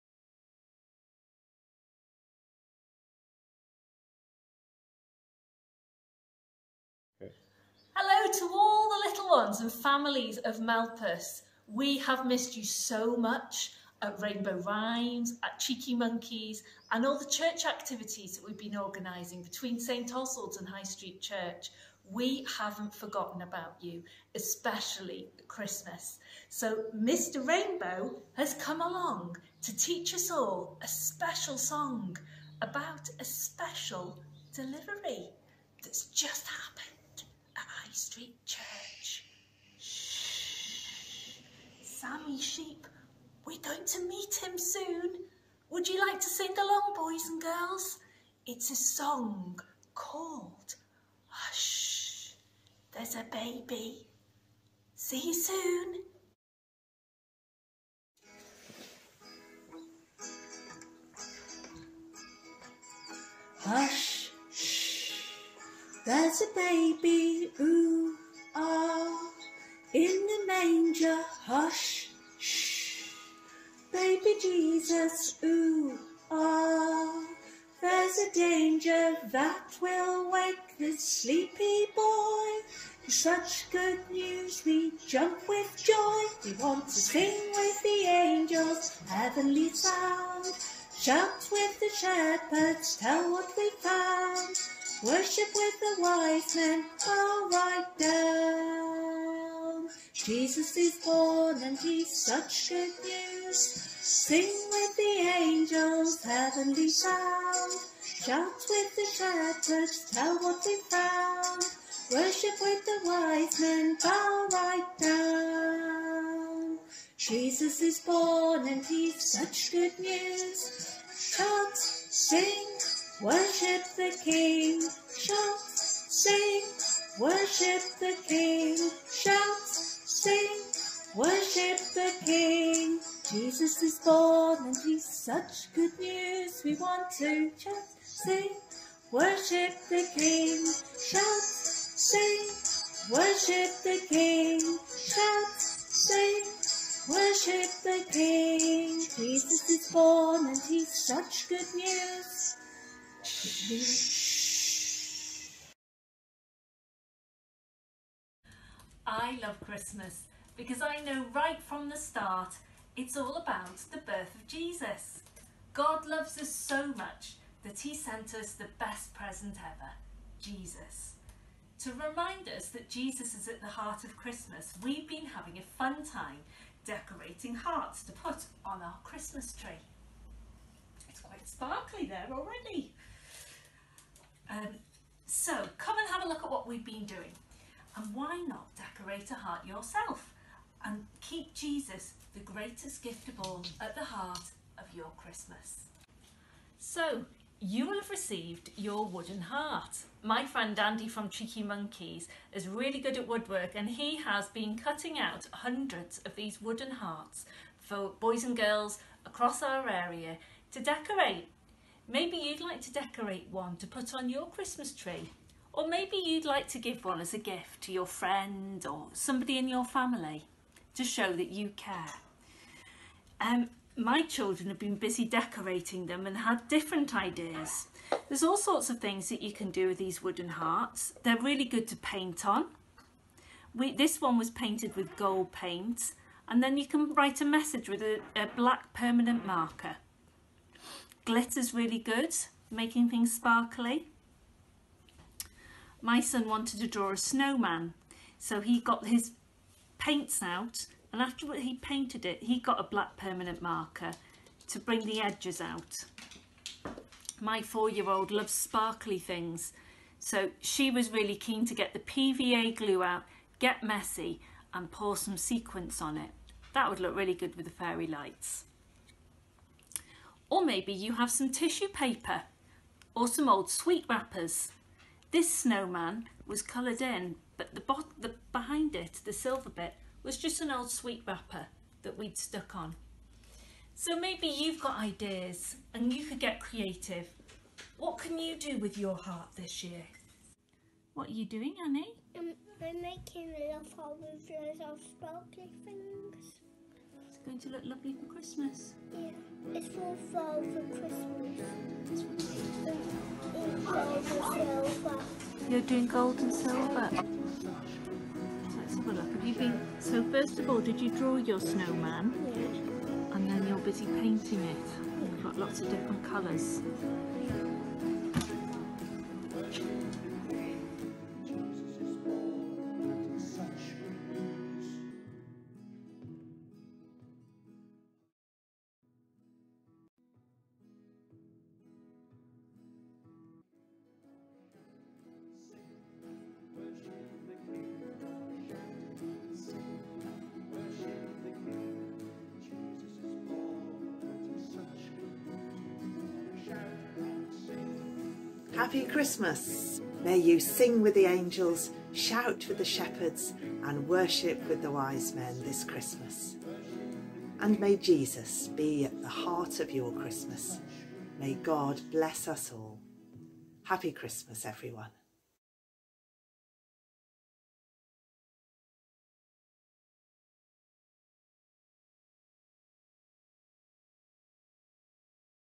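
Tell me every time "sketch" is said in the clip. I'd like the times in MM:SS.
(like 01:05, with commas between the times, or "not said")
not said.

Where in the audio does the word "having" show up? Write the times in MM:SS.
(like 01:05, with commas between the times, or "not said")
02:55.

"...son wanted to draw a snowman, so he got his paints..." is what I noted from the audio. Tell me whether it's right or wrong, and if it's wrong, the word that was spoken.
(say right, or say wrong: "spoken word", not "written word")
right.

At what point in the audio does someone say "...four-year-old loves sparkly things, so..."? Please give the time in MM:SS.
04:17.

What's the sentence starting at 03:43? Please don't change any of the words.
Um, my children have been busy decorating them and had different ideas.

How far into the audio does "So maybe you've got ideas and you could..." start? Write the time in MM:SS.
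04:43.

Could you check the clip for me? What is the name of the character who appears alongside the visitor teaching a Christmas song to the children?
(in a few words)
Mr Rainbow.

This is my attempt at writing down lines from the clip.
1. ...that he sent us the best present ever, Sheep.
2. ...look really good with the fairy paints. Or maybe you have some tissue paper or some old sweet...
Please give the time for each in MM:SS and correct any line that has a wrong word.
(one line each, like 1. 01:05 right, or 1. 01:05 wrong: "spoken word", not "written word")
1. 02:47 wrong: "Jesus", not "Sheep"
2. 04:26 wrong: "lights", not "paints".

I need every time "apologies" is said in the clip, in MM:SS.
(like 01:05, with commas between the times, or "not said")
not said.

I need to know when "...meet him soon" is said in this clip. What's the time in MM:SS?
00:44.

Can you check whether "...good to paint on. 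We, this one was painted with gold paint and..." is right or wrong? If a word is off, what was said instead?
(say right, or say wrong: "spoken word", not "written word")
right.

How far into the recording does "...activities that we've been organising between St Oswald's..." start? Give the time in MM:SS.
00:17.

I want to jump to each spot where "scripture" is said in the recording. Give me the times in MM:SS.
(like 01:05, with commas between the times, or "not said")
not said.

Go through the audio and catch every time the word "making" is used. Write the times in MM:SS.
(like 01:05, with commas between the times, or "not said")
04:02, 04:53.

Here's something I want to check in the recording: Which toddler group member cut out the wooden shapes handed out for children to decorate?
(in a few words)
Andy.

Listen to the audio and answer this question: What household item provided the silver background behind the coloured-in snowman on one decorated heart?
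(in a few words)
an old sweet wrapper.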